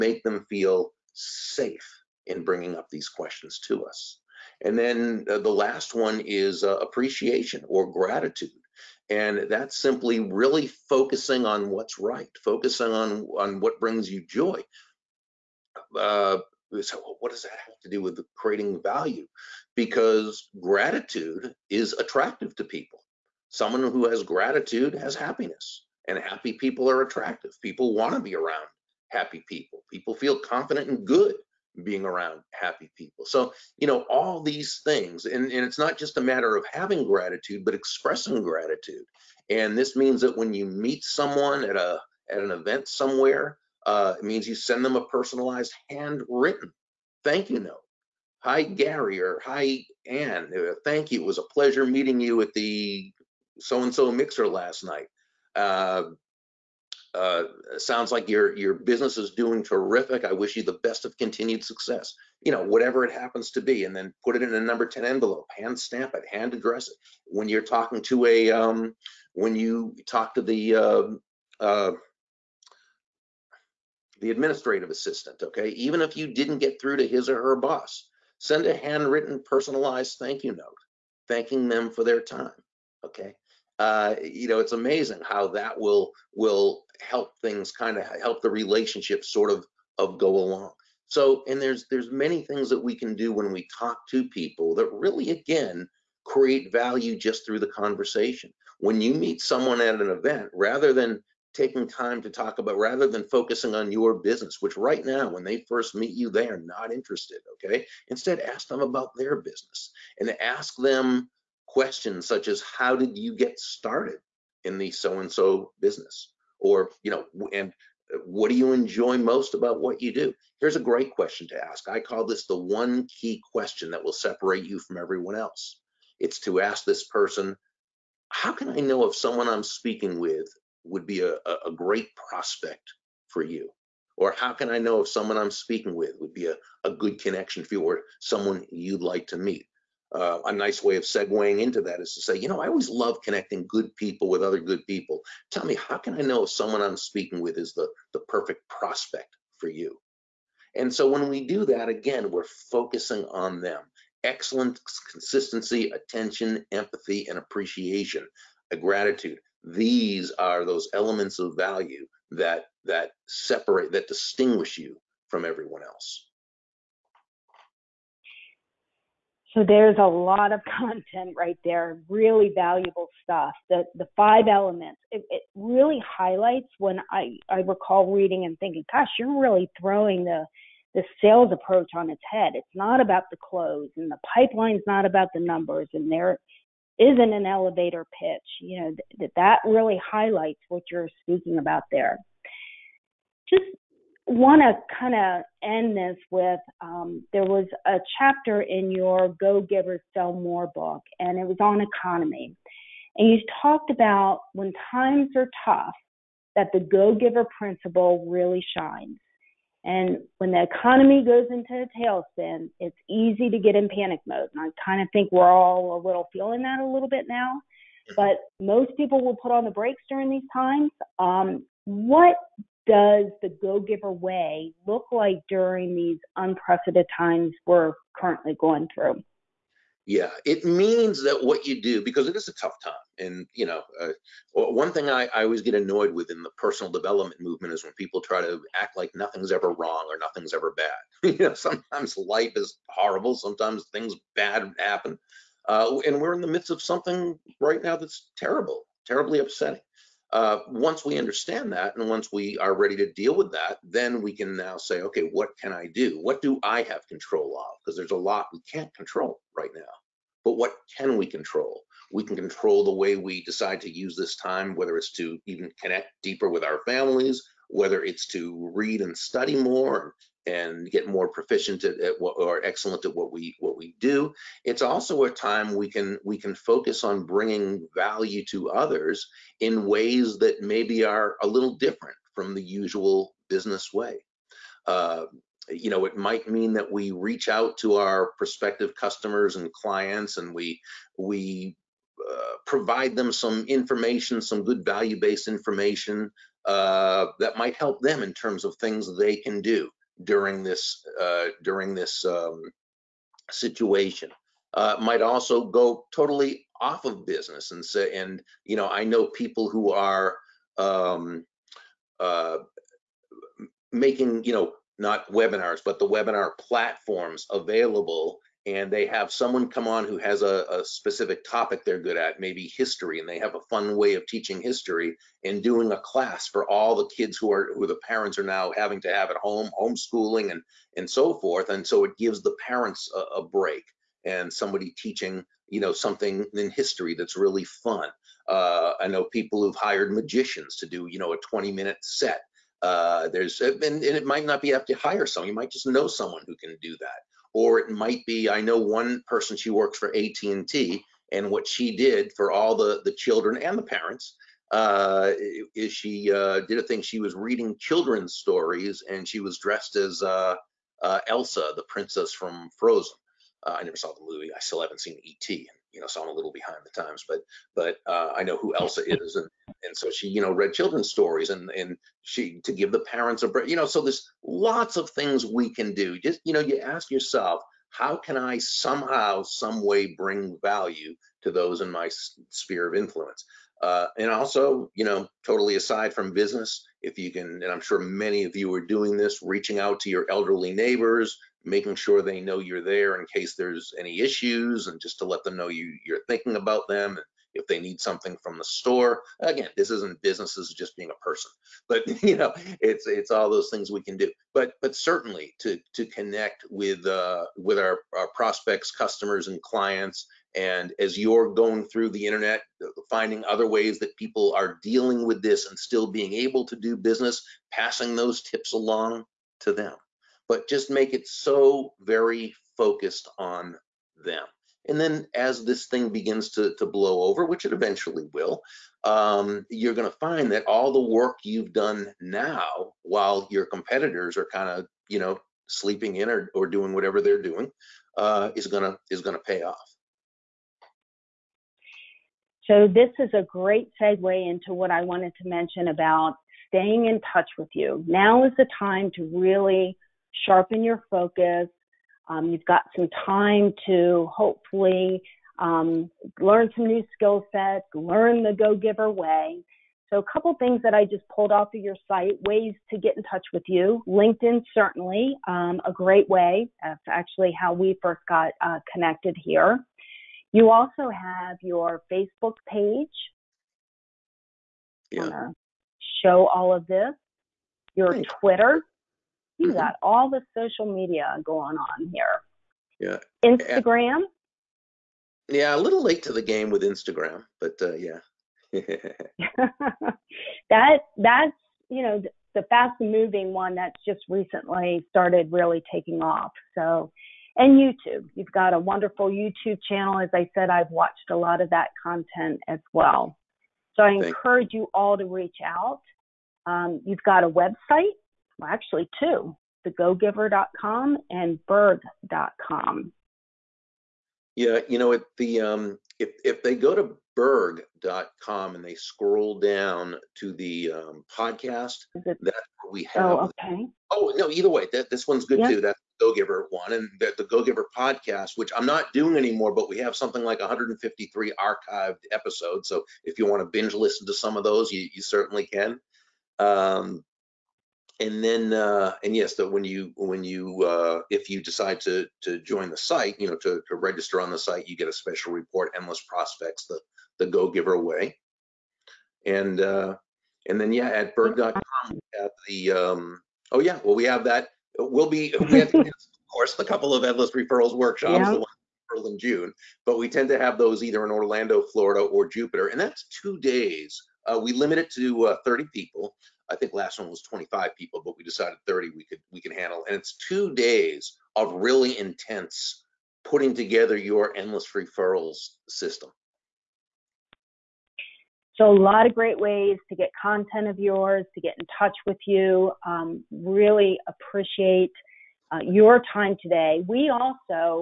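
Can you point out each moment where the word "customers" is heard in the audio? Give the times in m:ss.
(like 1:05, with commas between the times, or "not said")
4:48, 6:48.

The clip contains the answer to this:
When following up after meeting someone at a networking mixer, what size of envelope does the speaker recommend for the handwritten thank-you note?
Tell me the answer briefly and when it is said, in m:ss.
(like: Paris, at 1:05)
Number 10, at 1:04.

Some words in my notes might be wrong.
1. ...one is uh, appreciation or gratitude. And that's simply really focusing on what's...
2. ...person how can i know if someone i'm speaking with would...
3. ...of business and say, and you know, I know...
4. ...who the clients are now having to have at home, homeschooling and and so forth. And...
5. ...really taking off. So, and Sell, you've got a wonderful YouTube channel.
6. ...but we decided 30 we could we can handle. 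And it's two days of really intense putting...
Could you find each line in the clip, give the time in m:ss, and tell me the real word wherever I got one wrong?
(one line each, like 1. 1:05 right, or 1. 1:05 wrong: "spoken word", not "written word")
1. 0:05 right
2. 2:07 right
3. 5:07 right
4. 5:27 wrong: "parents", not "clients"
5. 8:15 wrong: "YouTube", not "Sell"
6. 9:28 right.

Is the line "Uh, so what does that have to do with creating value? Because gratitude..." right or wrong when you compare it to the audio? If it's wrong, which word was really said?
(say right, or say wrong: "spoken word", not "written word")
right.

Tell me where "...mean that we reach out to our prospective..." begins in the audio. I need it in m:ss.
4:46.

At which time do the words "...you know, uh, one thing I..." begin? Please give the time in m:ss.
3:53.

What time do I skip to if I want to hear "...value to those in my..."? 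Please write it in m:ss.
6:20.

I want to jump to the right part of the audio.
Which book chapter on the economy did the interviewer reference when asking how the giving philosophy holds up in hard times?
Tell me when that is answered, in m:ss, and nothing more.
3:19.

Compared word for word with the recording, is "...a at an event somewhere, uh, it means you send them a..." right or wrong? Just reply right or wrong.
right.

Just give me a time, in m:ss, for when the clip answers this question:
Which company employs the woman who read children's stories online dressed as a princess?
5:50.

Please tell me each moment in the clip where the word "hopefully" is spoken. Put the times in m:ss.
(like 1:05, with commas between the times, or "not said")
7:34.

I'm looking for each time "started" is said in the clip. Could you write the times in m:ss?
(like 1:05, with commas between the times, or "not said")
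1:53, 8:15.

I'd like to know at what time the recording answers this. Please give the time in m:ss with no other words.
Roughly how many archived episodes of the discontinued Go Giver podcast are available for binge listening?
8:50.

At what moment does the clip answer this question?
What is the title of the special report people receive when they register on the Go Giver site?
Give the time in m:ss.
9:05.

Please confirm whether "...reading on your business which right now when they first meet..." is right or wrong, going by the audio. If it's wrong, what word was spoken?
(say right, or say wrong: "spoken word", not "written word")
wrong: "focusing", not "reading".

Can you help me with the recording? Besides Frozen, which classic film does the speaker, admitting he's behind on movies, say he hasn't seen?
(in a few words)
E.T.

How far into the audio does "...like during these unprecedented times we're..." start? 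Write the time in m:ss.
3:45.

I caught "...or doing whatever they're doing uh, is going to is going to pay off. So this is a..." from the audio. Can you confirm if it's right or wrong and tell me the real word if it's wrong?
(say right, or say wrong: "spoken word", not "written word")
right.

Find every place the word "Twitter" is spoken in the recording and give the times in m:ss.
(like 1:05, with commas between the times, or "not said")
7:58.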